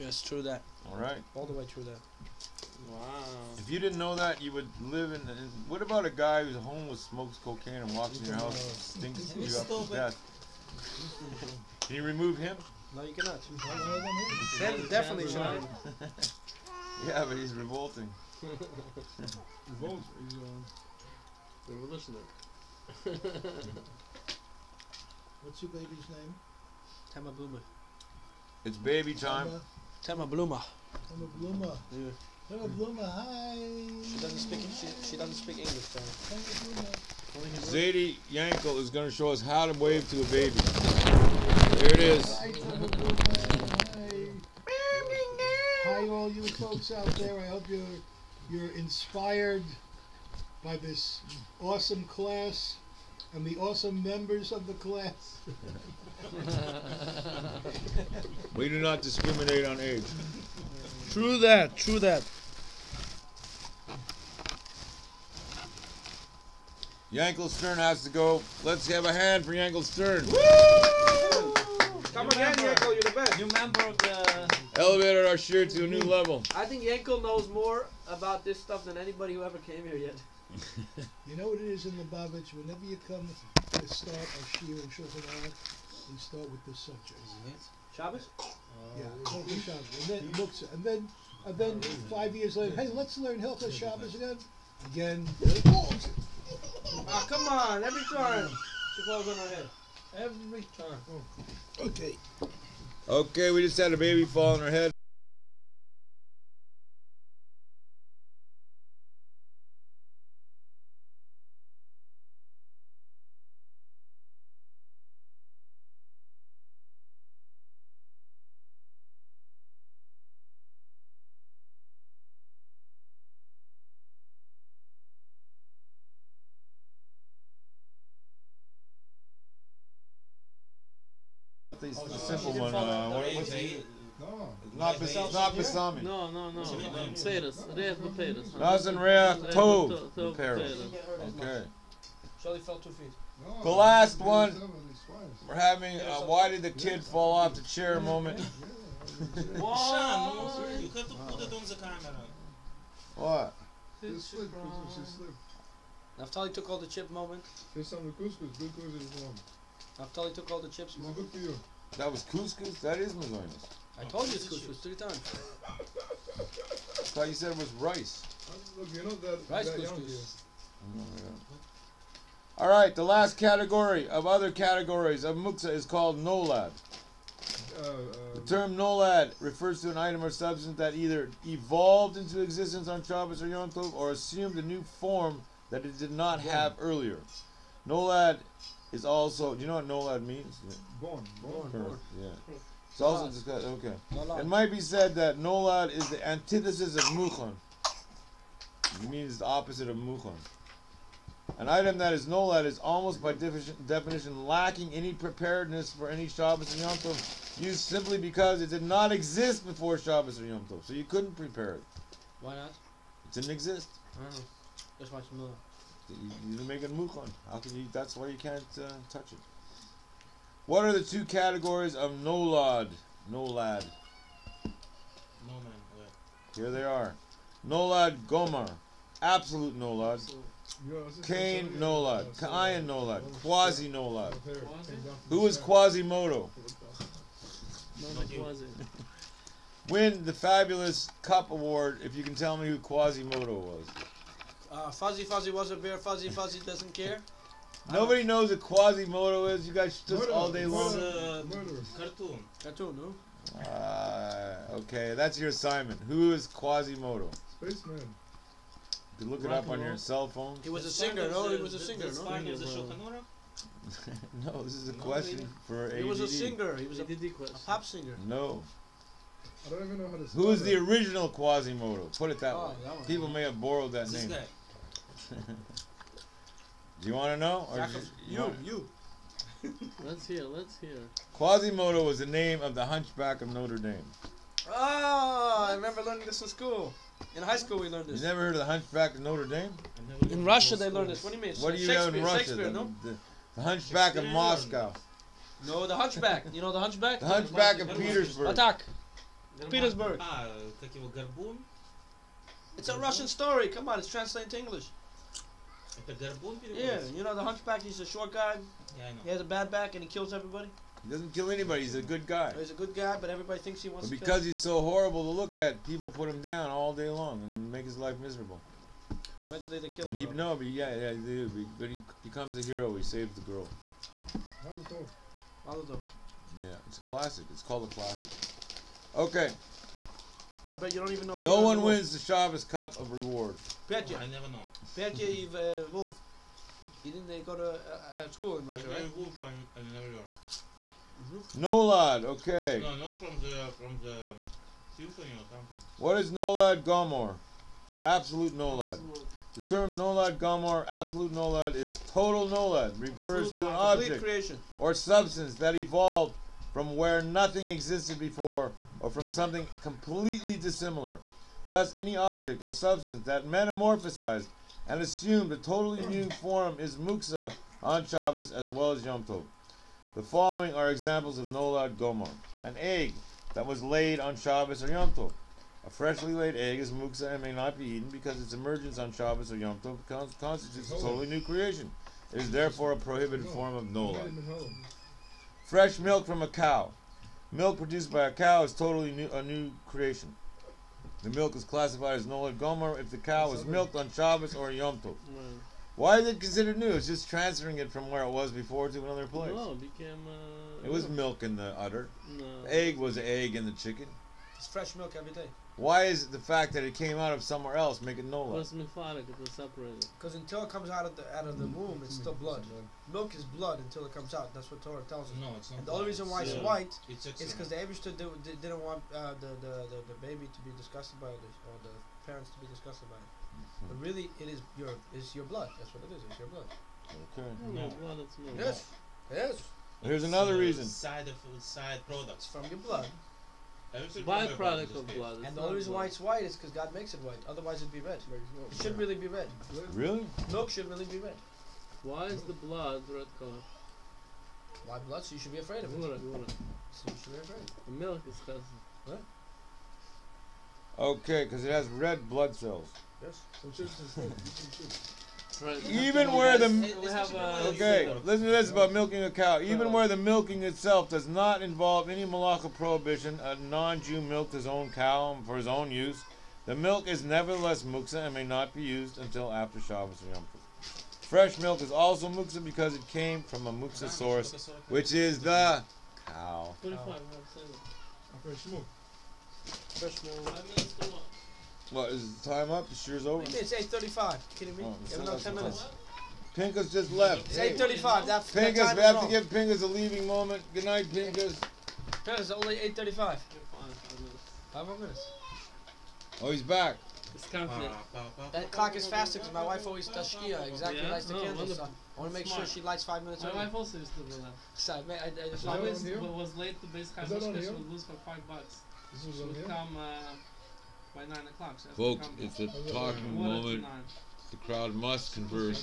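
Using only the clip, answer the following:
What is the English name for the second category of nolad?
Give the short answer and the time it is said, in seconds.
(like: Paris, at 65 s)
Quasi Nolad, at 233 s.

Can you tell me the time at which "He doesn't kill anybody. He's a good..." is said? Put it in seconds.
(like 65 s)
311 s.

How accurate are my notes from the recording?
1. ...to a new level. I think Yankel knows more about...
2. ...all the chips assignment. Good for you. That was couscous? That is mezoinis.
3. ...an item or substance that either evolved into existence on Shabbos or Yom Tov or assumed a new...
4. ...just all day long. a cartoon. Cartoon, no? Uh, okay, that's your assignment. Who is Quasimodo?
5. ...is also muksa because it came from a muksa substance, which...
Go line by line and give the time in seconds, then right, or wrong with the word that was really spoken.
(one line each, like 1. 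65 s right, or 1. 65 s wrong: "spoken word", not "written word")
1. 75 s right
2. 160 s wrong: "moment", not "assignment"
3. 179 s right
4. 250 s right
5. 471 s wrong: "source", not "substance".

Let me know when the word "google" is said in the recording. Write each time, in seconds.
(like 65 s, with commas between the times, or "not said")
not said.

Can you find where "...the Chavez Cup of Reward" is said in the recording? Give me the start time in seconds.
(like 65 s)
332 s.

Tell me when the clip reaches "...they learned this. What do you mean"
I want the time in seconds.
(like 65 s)
290 s.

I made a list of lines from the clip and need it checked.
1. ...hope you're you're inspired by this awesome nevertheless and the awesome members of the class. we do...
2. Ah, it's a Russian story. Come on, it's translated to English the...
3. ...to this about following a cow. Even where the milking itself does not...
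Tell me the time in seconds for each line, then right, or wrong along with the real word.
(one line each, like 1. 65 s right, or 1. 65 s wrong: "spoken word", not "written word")
1. 47 s wrong: "class", not "nevertheless"
2. 300 s right
3. 458 s wrong: "milking", not "following".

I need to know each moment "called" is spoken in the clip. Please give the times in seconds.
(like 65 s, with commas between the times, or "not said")
175 s, 327 s.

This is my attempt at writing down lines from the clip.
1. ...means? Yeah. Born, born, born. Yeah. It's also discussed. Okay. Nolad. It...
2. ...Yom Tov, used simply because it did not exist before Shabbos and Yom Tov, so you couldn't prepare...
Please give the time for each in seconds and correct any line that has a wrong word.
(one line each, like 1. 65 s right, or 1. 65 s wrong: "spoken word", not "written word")
1. 190 s right
2. 206 s right.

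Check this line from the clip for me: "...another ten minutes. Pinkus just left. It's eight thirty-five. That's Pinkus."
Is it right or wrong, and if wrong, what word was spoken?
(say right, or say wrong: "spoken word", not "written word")
right.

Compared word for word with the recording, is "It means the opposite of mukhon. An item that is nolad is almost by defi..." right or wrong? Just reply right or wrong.
right.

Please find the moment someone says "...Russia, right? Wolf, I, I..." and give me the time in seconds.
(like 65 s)
338 s.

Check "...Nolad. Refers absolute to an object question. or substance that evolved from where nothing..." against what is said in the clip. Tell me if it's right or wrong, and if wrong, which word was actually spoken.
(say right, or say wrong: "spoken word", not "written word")
wrong: "creation", not "question".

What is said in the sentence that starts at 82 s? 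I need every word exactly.
Whenever you come to start a shiur in Shulchan Aruch, start with this subject.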